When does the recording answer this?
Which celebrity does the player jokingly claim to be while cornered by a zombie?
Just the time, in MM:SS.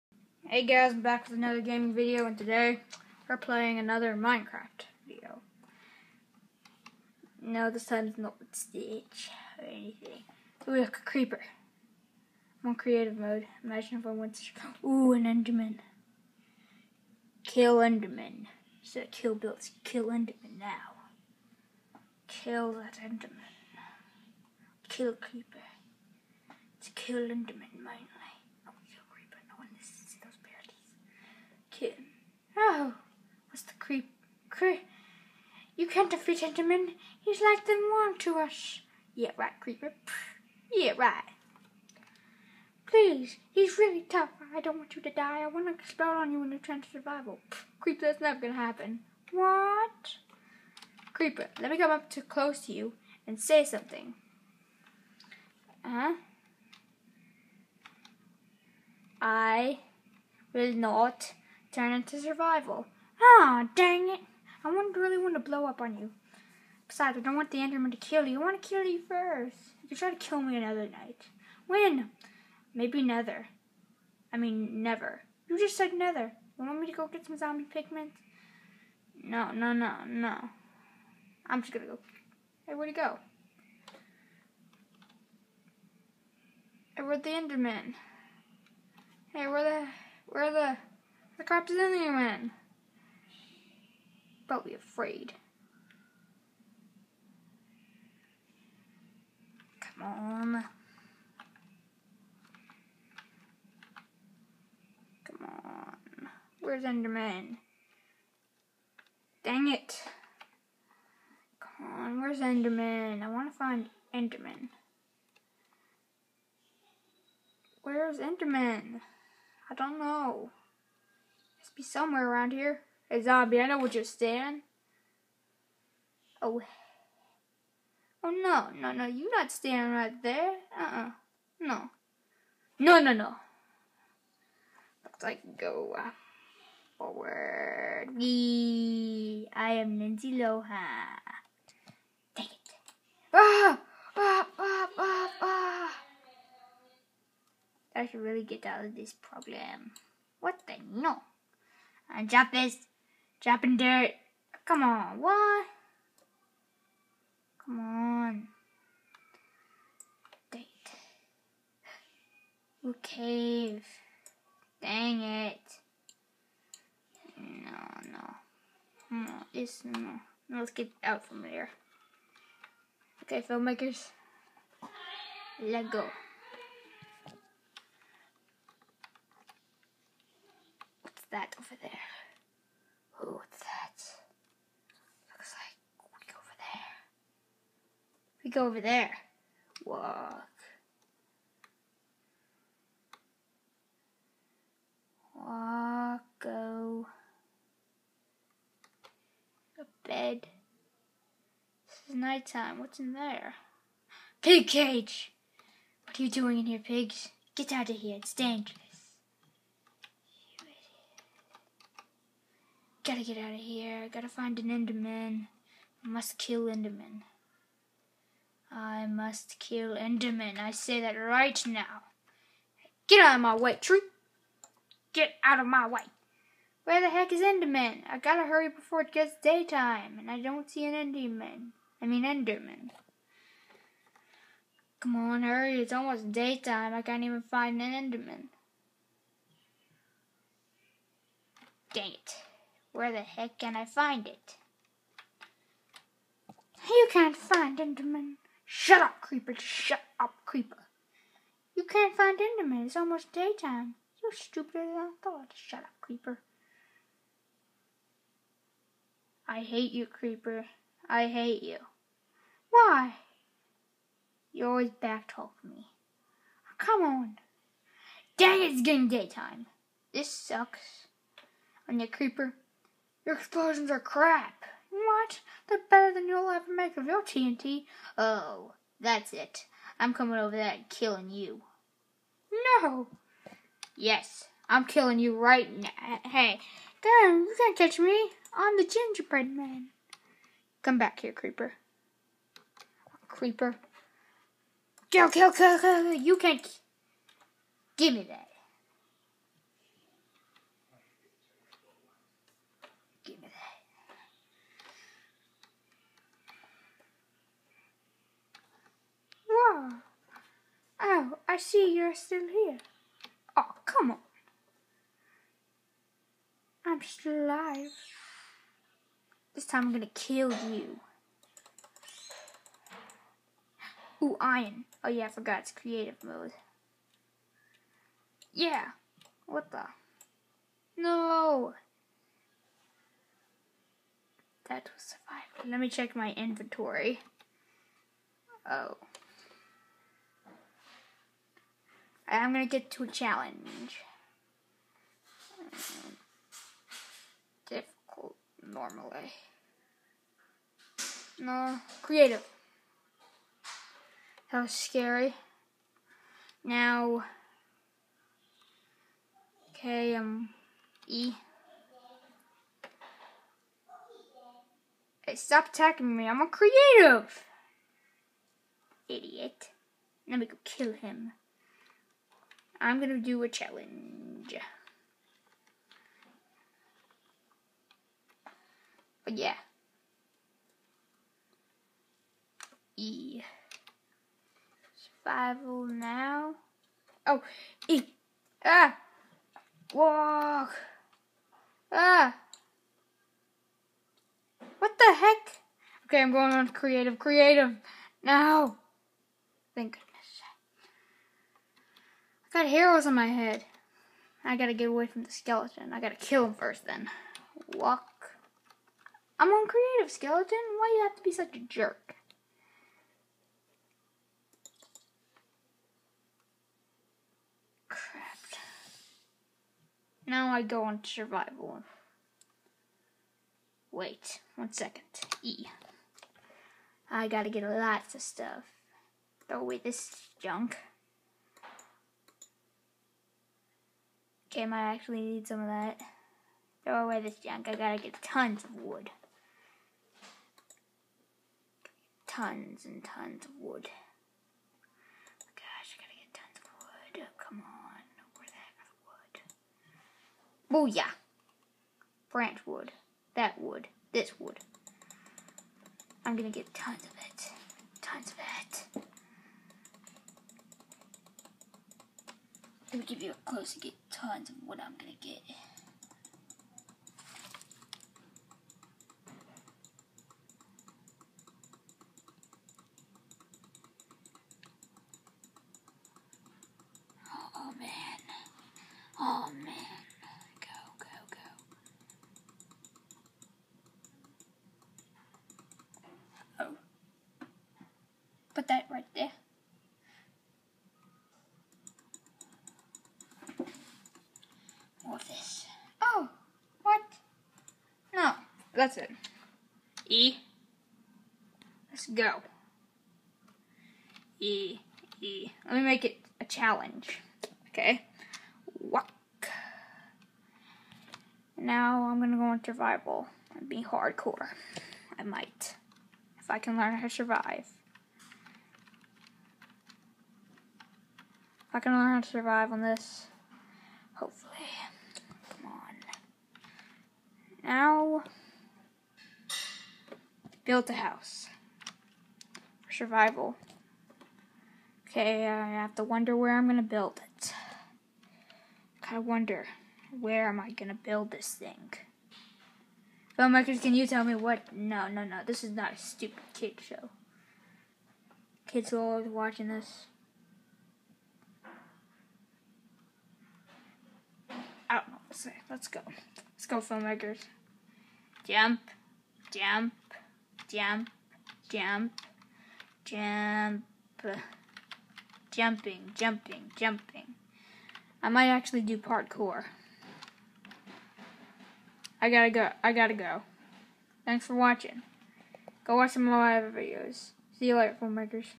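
02:19.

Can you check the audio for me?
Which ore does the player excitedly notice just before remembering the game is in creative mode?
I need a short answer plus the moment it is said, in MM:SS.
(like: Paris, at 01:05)
Iron, at 05:24.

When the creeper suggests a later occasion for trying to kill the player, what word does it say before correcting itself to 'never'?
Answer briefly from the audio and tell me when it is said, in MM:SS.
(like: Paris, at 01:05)
Nether, at 01:12.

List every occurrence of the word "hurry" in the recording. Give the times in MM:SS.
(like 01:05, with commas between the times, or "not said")
03:48, 03:55.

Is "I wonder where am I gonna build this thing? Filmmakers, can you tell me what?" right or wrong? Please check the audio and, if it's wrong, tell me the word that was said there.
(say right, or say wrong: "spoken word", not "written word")
right.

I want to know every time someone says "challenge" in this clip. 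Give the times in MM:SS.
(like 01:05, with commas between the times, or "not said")
05:43, 06:13, 08:26.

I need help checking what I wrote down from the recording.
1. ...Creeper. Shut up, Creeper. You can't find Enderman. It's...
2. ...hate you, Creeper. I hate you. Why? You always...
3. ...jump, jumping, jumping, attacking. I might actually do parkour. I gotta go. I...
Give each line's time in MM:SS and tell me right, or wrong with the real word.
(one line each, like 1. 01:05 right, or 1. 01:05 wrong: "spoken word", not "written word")
1. 04:09 right
2. 04:19 right
3. 09:23 wrong: "jumping", not "attacking".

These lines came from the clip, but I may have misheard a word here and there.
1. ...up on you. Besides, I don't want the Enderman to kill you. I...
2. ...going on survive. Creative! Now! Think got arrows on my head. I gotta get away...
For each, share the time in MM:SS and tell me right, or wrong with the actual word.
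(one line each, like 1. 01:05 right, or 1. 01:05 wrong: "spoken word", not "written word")
1. 01:05 right
2. 06:36 wrong: "creative", not "survive".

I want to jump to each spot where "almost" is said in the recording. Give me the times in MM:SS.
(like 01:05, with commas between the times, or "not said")
03:55, 04:12.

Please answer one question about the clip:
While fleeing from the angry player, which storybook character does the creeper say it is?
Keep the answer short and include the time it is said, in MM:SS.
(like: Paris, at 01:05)
The gingerbread man, at 04:48.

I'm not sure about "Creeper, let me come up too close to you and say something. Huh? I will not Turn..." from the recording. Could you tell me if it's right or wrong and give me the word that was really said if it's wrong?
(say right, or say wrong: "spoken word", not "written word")
right.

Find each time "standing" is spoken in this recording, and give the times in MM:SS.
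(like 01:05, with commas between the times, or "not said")
02:09.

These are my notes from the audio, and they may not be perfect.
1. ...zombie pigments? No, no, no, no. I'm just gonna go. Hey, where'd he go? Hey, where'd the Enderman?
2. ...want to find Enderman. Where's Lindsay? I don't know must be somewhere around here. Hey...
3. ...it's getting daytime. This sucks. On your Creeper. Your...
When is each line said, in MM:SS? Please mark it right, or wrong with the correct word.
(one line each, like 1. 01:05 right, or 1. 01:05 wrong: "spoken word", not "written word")
1. 01:17 right
2. 01:53 wrong: "Enderman", not "Lindsay"
3. 04:28 right.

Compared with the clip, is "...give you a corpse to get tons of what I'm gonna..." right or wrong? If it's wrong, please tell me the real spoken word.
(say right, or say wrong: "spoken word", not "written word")
wrong: "close", not "corpse".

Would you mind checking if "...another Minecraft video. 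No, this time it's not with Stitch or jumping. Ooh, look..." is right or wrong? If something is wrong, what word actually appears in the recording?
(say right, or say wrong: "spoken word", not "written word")
wrong: "anything", not "jumping".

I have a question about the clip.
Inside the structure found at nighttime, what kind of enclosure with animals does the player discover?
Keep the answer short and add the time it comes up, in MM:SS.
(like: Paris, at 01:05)
Pig cage, at 03:24.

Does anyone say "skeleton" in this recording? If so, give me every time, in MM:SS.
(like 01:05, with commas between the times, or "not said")
06:45, 06:50.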